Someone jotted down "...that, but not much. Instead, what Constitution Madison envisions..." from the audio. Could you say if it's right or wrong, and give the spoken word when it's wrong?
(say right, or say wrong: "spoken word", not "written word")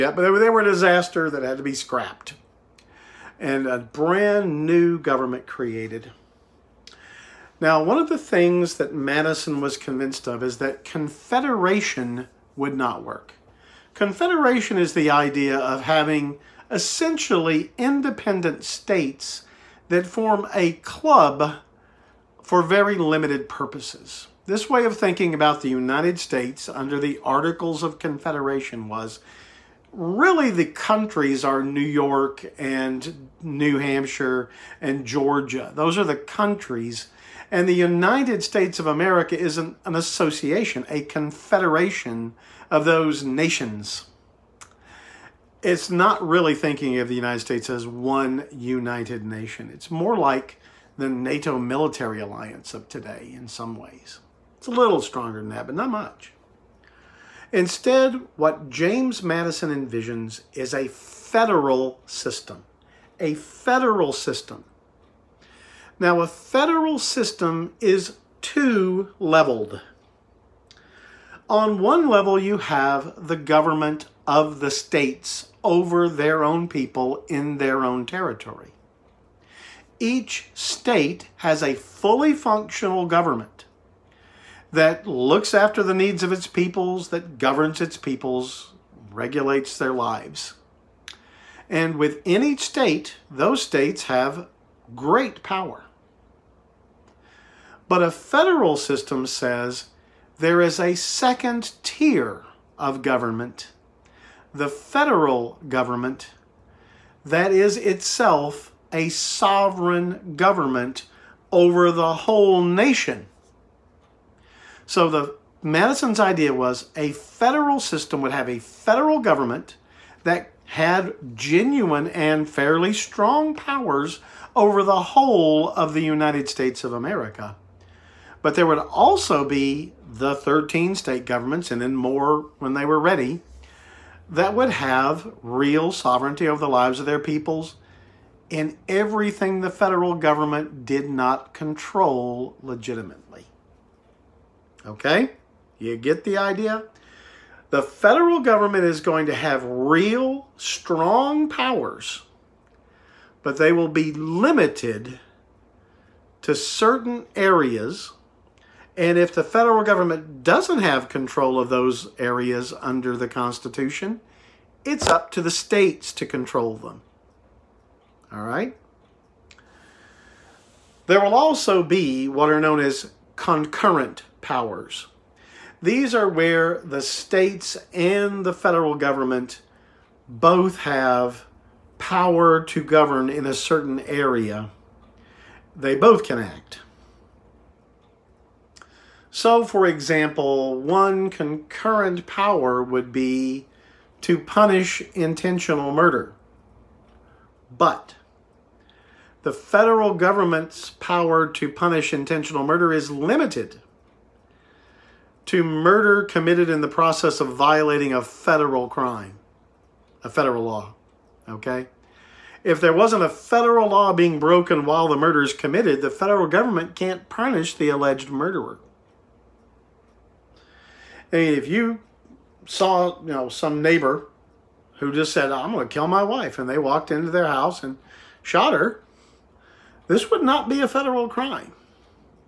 wrong: "James", not "Constitution".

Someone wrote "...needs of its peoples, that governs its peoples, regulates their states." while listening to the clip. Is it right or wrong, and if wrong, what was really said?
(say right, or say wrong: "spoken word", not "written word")
wrong: "lives", not "states".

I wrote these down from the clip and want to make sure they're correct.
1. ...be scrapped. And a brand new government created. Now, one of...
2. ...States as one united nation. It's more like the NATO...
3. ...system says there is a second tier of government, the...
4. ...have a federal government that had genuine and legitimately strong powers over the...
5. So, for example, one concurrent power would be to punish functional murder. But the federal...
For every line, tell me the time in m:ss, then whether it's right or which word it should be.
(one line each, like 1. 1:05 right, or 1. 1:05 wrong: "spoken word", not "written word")
1. 0:01 right
2. 0:47 right
3. 1:38 right
4. 1:58 wrong: "fairly", not "legitimately"
5. 3:09 wrong: "intentional", not "functional".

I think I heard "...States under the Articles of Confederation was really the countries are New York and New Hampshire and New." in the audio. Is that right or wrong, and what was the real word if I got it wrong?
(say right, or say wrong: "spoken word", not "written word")
wrong: "Georgia", not "New".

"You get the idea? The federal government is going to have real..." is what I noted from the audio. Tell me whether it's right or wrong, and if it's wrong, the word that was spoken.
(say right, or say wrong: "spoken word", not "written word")
right.